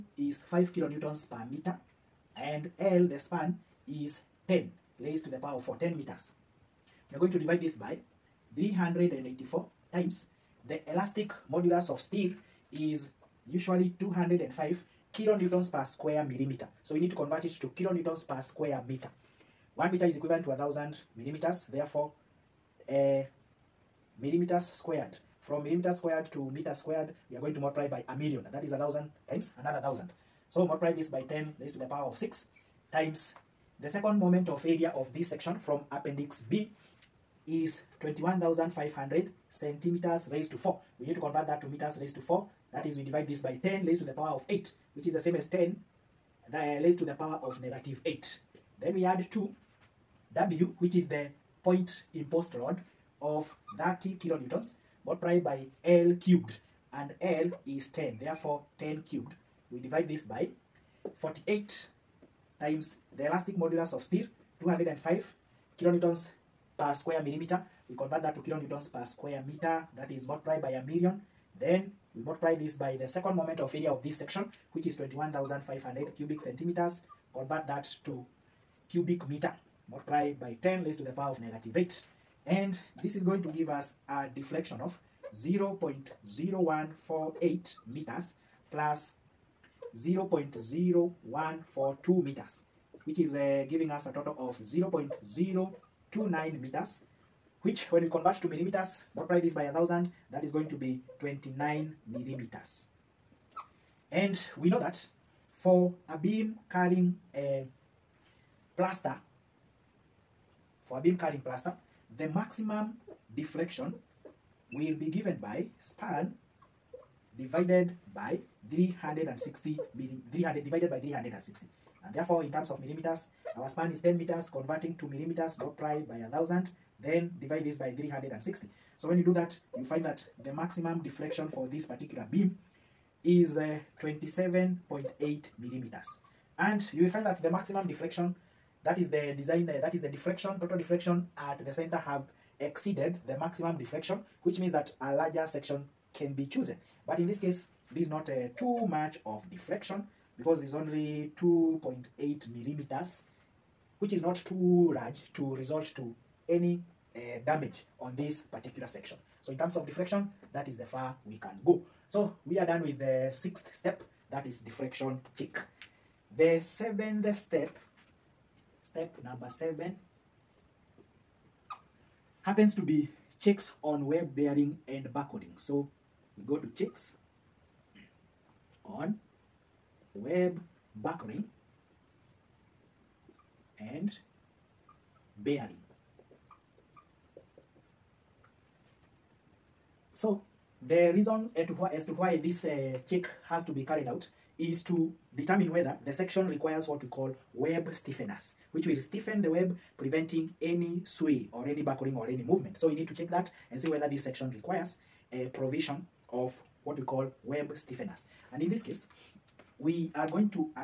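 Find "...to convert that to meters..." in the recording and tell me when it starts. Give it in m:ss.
0:41.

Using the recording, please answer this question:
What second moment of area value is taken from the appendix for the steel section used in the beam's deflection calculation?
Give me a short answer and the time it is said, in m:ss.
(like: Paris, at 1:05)
21,500 cm^4, at 0:38.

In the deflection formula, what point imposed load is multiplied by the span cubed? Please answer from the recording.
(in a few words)
30 kN.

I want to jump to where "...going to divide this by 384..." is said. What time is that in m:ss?
0:07.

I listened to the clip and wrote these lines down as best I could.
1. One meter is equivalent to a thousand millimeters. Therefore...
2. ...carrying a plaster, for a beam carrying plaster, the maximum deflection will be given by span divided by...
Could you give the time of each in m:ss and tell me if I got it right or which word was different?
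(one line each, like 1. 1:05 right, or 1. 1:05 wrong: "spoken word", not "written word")
1. 0:19 right
2. 1:46 right.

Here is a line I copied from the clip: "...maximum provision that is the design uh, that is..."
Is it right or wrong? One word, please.
wrong.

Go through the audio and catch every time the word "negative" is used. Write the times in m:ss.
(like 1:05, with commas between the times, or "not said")
0:47, 1:21.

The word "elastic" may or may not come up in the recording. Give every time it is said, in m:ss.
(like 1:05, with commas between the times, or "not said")
0:10, 1:03.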